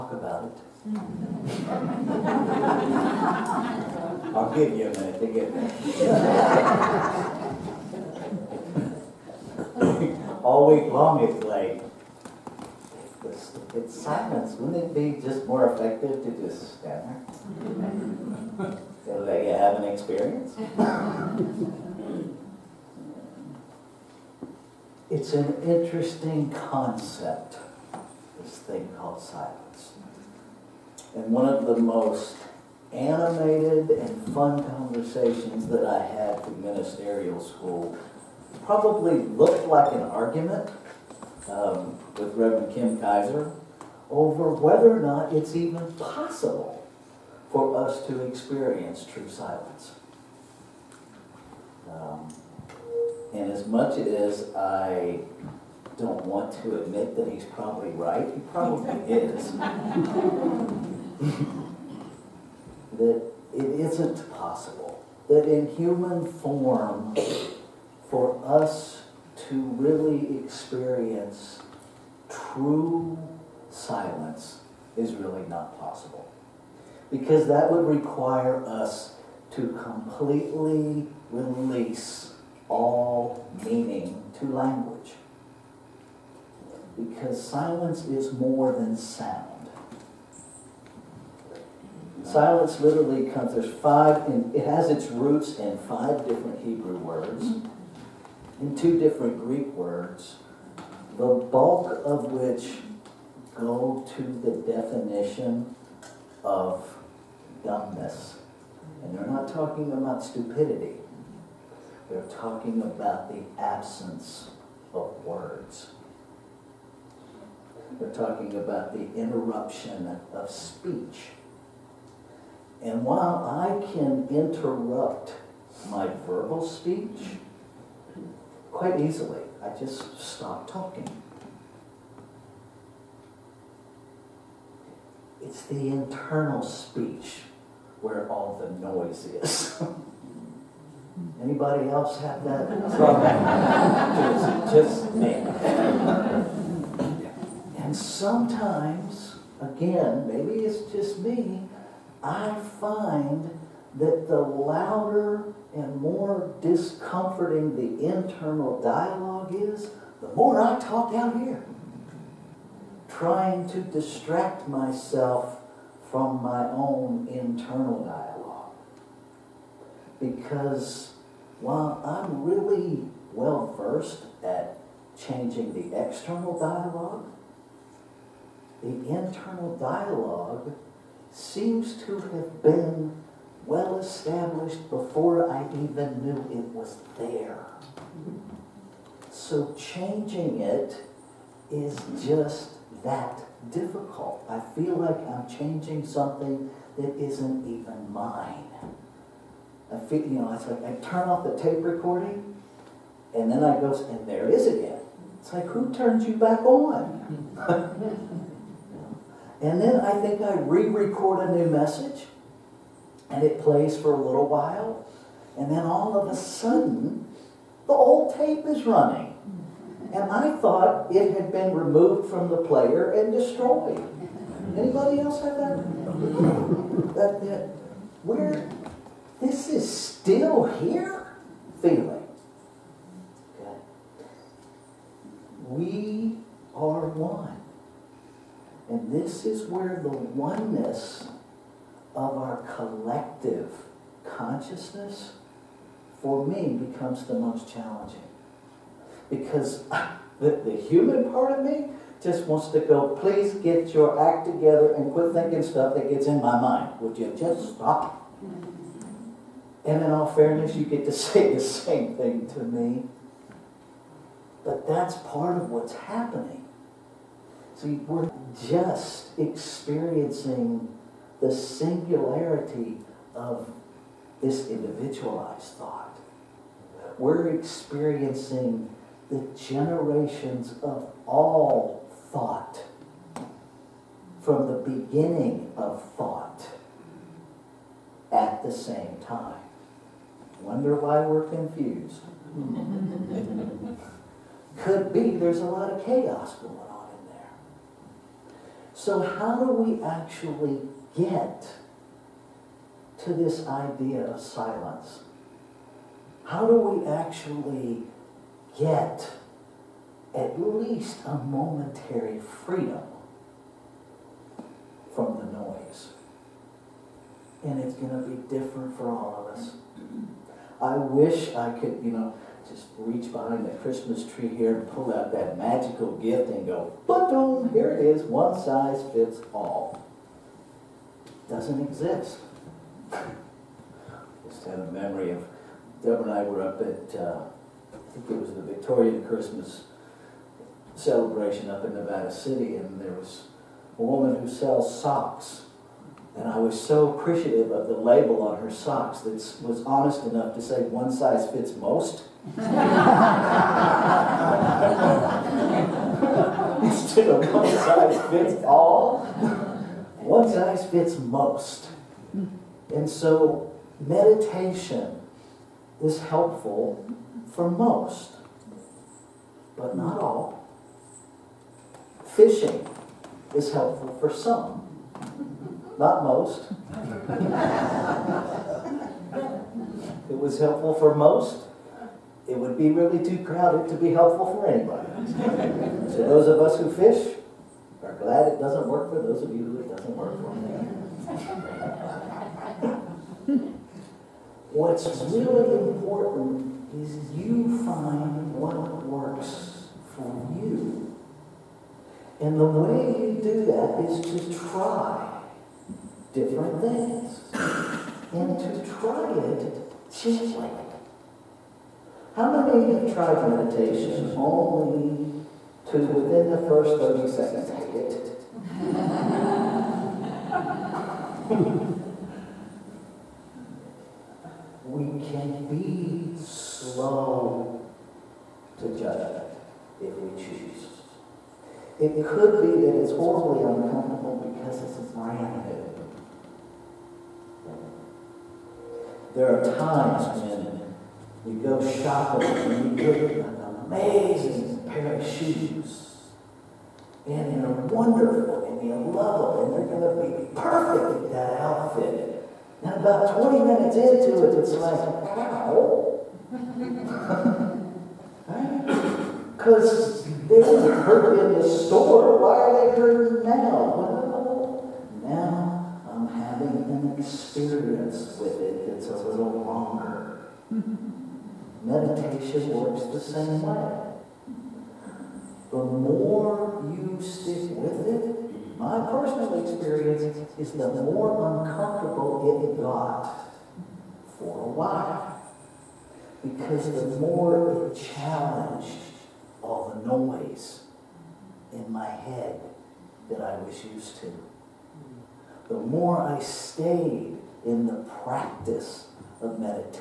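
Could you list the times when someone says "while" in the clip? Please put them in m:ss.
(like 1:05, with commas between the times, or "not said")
2:03, 2:51, 3:34, 8:04.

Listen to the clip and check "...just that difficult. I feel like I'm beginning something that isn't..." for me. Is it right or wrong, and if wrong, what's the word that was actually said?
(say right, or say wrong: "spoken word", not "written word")
wrong: "changing", not "beginning".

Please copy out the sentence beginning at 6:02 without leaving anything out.
And so meditation is helpful for most, but not all.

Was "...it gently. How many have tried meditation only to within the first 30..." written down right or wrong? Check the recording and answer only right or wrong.
right.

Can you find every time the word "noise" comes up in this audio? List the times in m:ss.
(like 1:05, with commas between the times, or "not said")
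2:18, 5:15, 8:10.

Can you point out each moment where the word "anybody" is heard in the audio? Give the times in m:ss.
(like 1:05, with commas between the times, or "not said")
2:21, 3:44, 6:24.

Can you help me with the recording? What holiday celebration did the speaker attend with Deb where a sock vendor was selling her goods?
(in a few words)
Victorian Christmas celebration.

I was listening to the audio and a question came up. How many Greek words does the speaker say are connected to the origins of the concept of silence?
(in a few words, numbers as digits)
2.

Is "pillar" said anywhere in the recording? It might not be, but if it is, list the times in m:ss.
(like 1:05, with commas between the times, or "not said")
not said.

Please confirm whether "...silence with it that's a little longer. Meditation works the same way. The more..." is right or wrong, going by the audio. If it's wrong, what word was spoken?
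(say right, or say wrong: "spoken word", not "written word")
wrong: "experience", not "silence".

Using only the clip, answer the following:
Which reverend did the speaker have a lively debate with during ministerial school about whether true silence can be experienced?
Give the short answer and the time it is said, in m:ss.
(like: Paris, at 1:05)
Kim Kaiser, at 0:42.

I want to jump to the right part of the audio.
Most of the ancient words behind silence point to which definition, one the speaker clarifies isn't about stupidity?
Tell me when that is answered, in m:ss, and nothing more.
1:47.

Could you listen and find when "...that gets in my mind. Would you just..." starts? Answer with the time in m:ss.
4:15.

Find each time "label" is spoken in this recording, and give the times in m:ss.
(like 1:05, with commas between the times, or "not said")
5:47.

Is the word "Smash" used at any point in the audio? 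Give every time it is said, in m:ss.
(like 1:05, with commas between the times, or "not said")
not said.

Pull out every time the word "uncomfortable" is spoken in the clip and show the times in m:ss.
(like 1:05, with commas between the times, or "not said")
7:13, 8:01.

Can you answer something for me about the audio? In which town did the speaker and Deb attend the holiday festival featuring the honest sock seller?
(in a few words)
Nevada City.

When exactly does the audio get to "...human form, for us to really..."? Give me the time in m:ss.
1:05.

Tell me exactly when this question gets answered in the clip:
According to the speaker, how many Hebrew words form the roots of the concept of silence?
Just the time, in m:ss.
1:35.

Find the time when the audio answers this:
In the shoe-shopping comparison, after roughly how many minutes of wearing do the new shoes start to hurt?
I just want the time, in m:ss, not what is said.
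7:33.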